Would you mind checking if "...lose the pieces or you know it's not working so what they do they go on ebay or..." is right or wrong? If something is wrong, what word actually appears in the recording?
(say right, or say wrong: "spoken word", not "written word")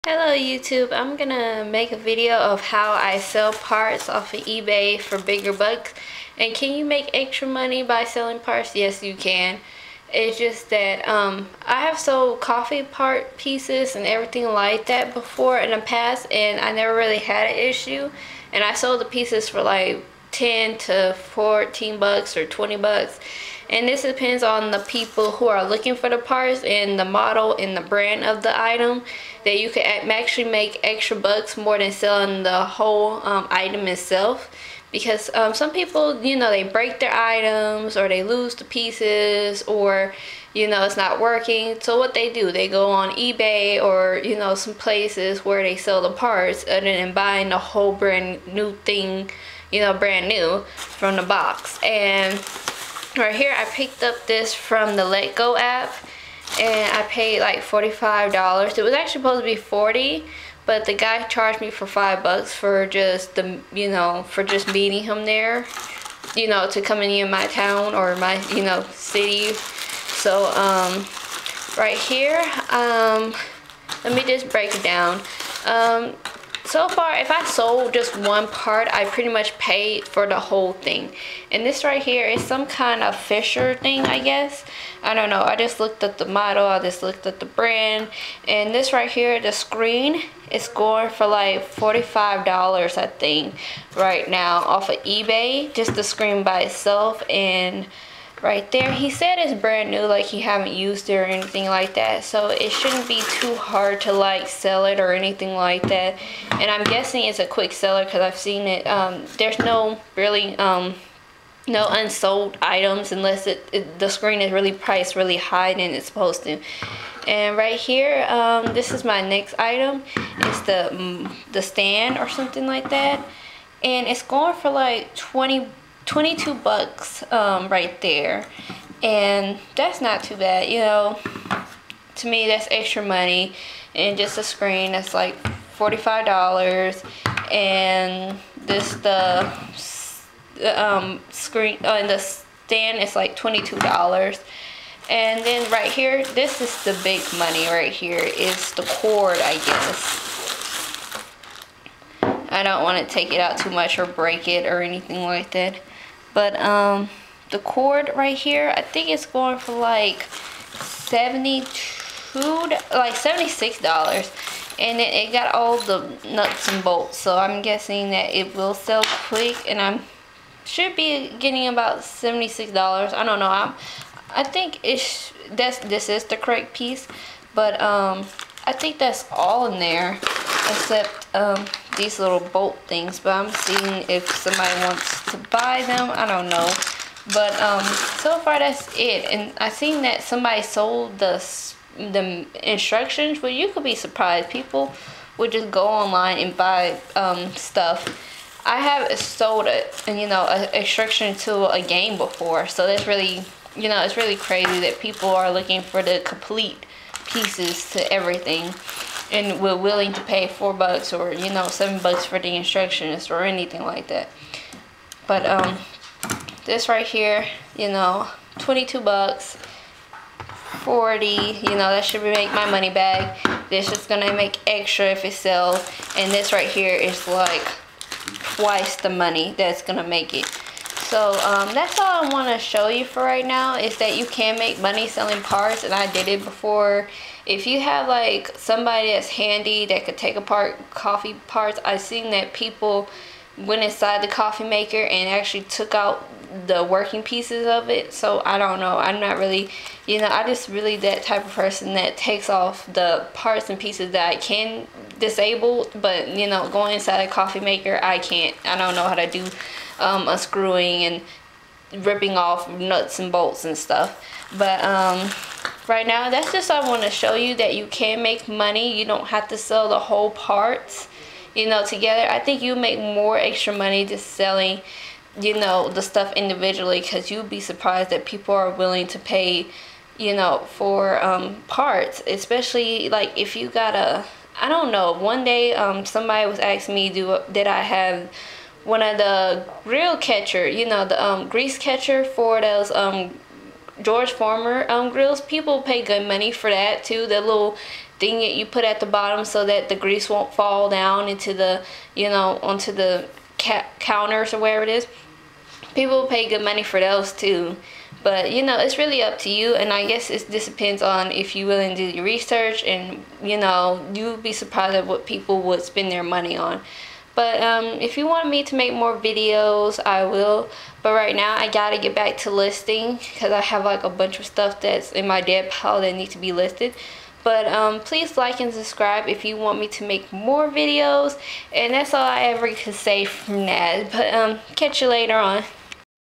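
right.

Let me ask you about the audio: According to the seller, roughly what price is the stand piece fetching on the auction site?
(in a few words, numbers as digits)
$22.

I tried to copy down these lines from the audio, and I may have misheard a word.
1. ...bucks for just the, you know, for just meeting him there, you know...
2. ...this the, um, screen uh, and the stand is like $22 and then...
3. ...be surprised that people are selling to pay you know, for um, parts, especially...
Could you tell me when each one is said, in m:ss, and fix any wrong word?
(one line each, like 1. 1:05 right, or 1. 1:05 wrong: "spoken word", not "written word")
1. 1:02 right
2. 2:18 right
3. 4:37 wrong: "willing", not "selling".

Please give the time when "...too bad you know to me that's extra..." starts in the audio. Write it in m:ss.
2:10.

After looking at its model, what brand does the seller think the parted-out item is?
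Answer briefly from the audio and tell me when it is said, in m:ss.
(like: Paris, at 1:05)
Fisher, at 1:23.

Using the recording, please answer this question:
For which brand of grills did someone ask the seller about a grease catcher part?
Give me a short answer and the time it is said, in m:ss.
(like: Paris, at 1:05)
George Foreman, at 4:54.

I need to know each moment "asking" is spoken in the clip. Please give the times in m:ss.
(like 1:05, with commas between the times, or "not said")
4:46.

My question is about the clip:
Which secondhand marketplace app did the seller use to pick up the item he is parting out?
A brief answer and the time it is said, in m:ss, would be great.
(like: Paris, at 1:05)
letgo, at 0:55.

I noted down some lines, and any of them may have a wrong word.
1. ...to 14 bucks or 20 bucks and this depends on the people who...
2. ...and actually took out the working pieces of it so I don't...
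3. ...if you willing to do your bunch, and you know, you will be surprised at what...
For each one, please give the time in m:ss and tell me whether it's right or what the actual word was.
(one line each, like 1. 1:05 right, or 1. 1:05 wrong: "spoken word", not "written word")
1. 0:20 right
2. 4:05 right
3. 5:11 wrong: "research", not "bunch".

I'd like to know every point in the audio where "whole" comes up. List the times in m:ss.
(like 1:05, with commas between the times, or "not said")
0:32, 0:47, 1:20, 4:29.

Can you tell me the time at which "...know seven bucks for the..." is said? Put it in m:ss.
3:31.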